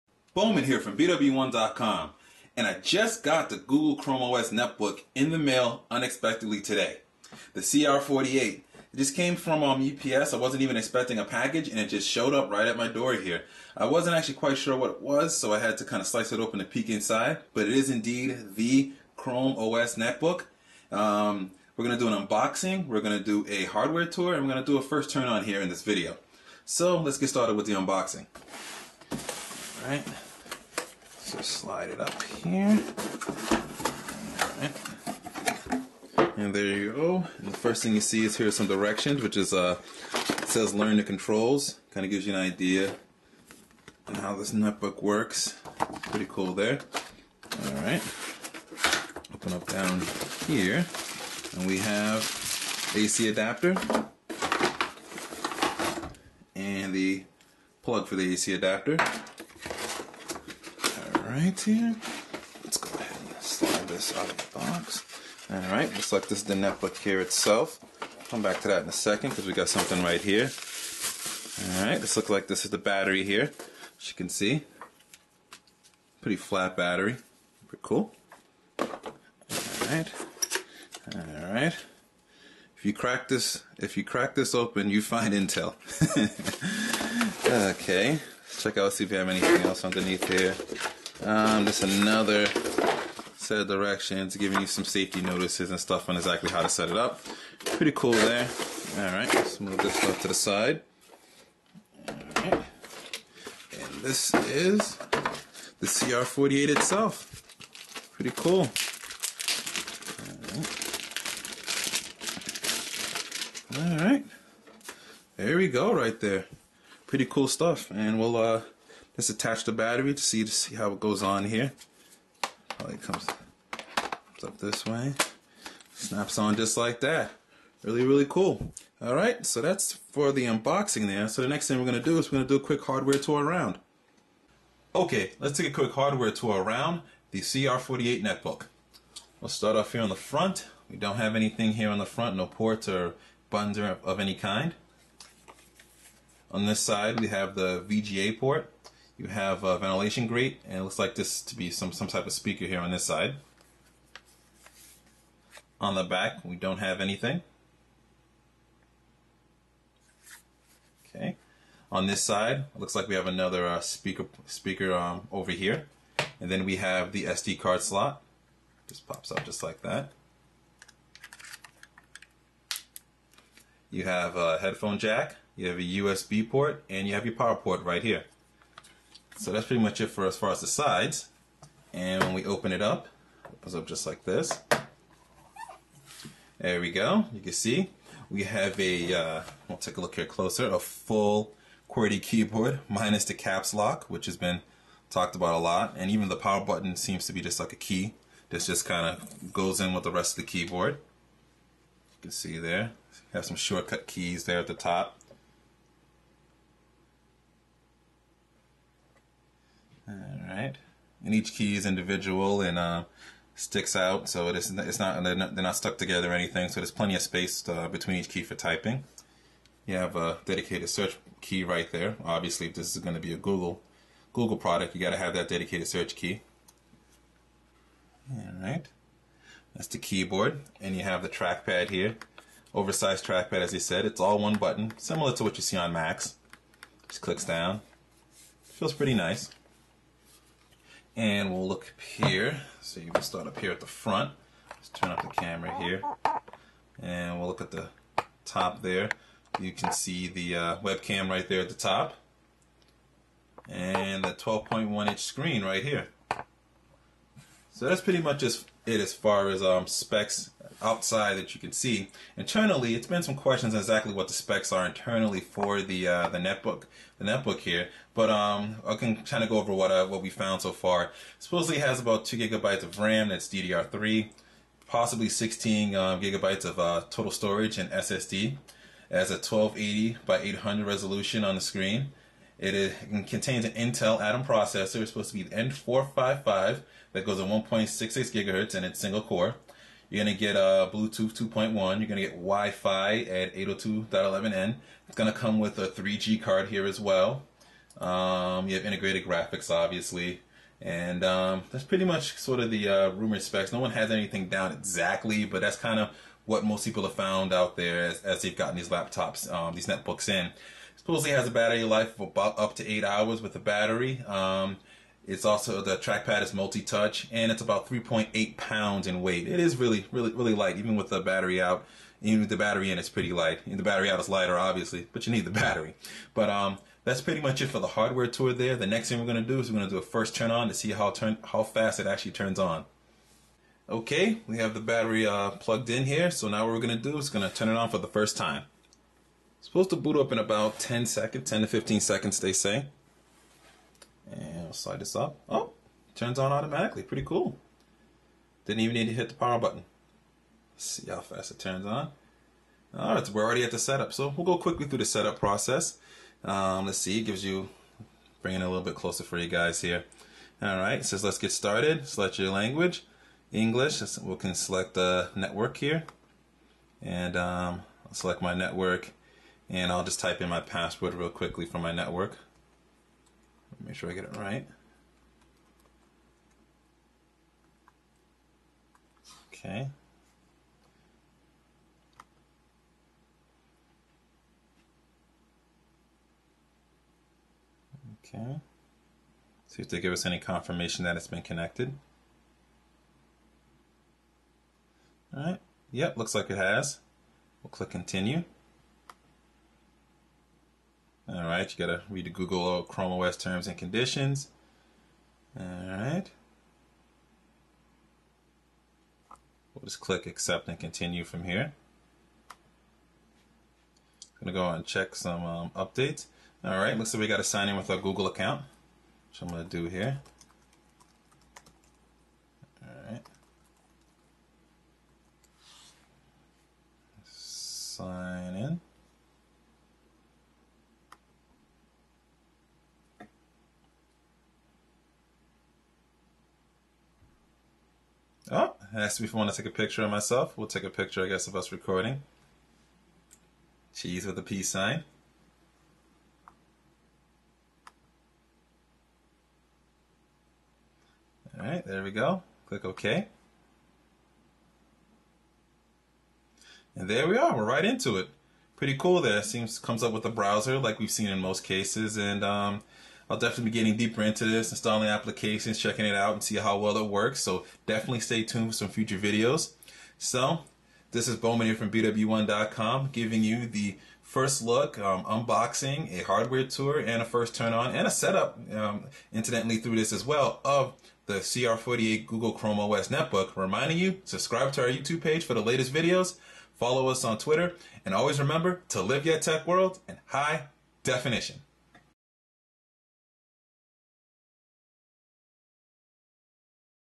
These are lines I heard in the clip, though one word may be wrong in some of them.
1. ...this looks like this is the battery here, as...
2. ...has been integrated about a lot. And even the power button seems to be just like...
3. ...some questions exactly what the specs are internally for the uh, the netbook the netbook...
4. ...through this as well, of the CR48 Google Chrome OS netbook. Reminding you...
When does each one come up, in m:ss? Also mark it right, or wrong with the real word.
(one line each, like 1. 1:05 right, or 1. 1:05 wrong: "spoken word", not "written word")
1. 1:12 right
2. 3:14 wrong: "talked", not "integrated"
3. 4:23 right
4. 7:59 right.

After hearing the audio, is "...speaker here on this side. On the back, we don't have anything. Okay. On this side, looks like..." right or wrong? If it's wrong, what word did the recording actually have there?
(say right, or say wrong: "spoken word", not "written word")
right.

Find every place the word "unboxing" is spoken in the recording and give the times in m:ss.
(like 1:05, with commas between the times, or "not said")
0:22, 0:27, 2:10, 7:55.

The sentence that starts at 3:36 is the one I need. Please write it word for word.
So there's plenty of space uh, between each key for typing.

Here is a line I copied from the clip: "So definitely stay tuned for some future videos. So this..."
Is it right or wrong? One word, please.
right.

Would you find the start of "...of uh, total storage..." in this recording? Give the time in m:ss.
4:36.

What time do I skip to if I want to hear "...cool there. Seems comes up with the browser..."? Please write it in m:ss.
7:38.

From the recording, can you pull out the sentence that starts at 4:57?
Um, you have integrated graphics, obviously.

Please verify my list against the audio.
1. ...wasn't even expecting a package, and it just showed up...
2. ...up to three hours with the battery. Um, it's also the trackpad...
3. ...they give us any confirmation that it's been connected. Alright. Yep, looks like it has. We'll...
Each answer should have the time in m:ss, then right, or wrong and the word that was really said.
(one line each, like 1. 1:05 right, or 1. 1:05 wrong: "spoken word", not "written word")
1. 0:10 right
2. 5:12 wrong: "eight", not "three"
3. 6:29 right.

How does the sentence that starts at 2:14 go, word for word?
Okay, let's take a quick hardware tour around the CR48 netbook.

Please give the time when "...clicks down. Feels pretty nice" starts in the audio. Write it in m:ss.
3:57.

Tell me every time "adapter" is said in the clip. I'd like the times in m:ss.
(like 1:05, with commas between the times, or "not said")
0:53, 0:58.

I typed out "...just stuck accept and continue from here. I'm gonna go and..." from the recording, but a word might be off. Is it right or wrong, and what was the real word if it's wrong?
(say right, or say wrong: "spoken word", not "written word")
wrong: "click", not "stuck".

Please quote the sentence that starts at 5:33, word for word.
Okay, we have the battery uh, plugged in here.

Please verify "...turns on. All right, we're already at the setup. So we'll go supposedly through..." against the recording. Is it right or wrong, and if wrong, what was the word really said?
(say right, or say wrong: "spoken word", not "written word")
wrong: "quickly", not "supposedly".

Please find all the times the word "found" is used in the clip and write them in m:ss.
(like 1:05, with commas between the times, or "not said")
4:30, 5:07.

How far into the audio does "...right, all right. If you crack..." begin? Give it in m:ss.
1:19.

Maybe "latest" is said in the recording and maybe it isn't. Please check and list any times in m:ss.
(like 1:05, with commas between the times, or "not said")
8:05.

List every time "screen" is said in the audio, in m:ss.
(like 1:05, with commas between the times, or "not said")
4:15, 4:41.